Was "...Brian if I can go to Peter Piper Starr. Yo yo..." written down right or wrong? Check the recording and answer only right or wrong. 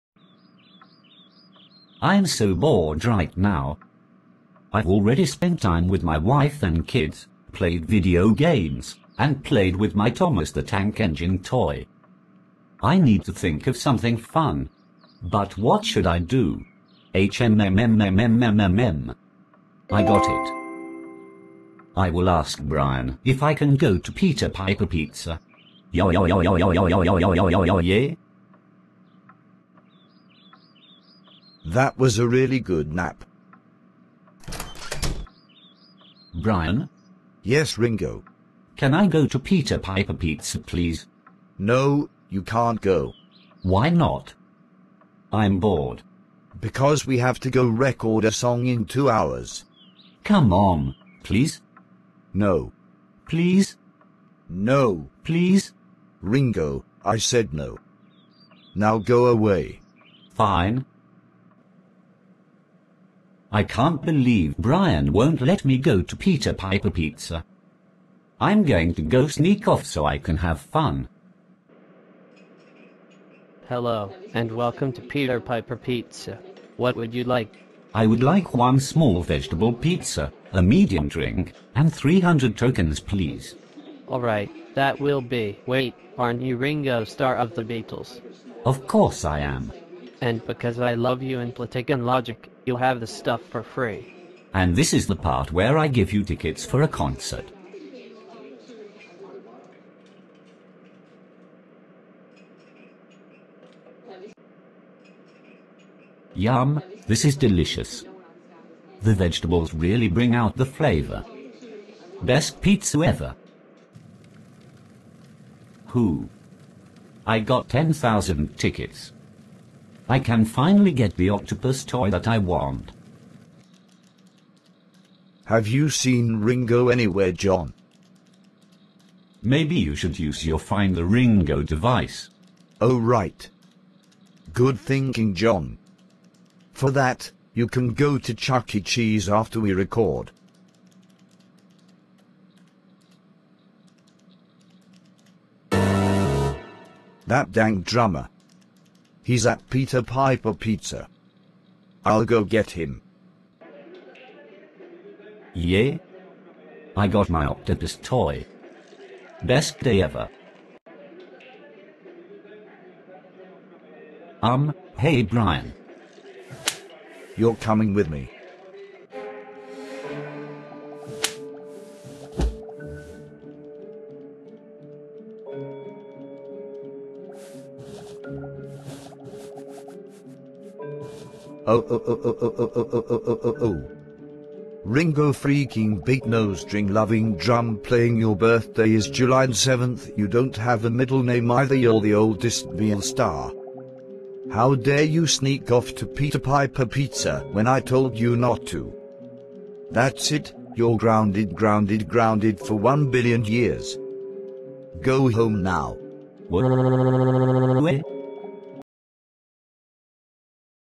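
wrong.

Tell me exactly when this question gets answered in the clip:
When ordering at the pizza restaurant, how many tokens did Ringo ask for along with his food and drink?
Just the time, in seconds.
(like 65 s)
81 s.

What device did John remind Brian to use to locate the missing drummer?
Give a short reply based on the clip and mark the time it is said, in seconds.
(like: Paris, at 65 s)
Find the Ringo device, at 130 s.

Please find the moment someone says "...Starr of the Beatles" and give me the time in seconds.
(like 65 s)
87 s.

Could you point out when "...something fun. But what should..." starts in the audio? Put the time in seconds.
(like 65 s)
13 s.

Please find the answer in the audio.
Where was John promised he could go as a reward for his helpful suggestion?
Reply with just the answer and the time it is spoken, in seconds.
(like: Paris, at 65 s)
Chuck E. Cheese, at 138 s.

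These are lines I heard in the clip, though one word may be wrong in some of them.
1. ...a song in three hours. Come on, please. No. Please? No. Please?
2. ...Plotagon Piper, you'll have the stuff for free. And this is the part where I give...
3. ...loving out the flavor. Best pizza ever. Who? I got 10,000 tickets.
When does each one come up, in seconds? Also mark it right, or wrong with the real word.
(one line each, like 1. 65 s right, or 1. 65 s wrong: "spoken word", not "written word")
1. 48 s wrong: "two", not "three"
2. 91 s wrong: "Logic", not "Piper"
3. 110 s wrong: "bring", not "loving".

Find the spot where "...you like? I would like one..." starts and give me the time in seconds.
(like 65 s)
77 s.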